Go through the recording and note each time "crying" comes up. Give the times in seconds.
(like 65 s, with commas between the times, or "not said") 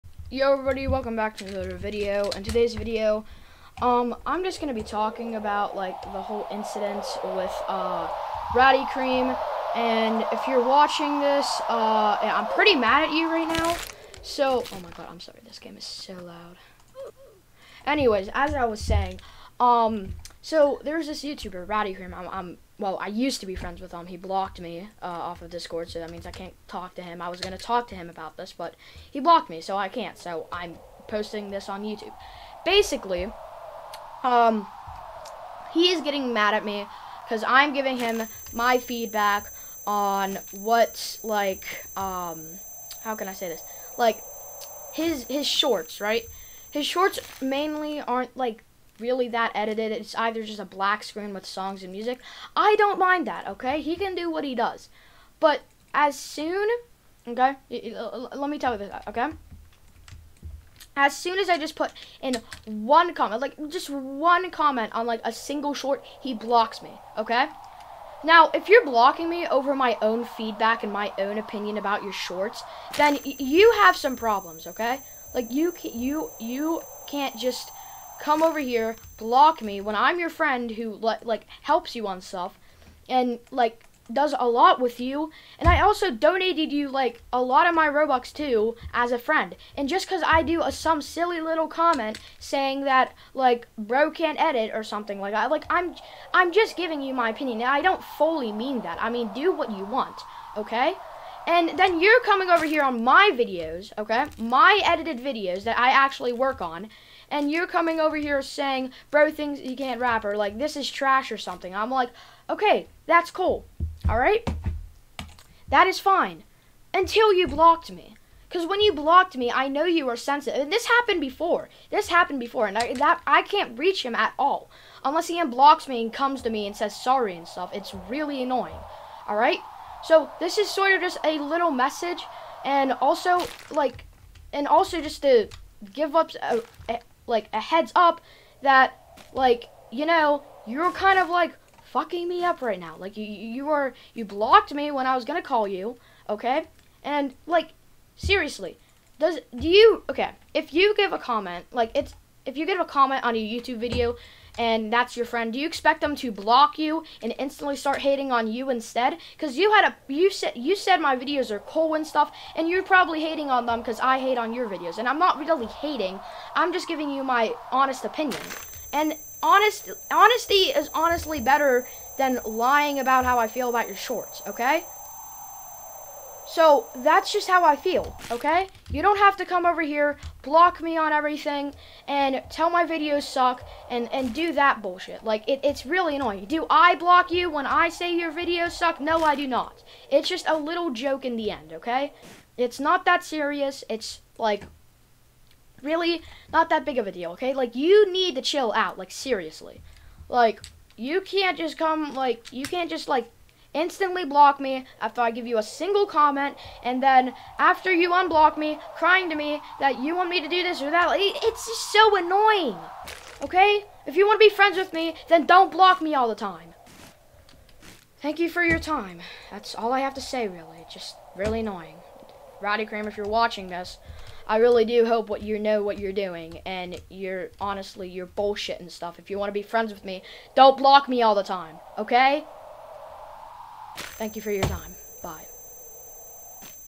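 208 s.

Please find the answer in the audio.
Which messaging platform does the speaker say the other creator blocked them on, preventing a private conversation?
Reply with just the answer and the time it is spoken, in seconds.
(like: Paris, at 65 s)
Discord, at 25 s.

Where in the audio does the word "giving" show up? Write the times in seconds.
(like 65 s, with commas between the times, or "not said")
37 s, 96 s, 166 s.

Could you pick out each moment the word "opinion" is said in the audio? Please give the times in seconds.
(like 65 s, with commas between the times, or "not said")
71 s, 97 s, 168 s.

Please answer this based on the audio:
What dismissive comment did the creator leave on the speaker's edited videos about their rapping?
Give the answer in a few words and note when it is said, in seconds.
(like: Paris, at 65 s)
bro things you can't rap, at 109 s.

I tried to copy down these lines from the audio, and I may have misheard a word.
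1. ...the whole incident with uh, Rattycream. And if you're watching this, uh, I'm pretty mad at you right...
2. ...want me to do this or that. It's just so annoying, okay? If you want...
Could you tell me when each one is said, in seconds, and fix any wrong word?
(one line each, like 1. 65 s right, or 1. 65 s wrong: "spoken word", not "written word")
1. 6 s right
2. 210 s right.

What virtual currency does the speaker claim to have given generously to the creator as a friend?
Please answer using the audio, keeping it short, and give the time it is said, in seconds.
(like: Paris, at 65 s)
Robux, at 87 s.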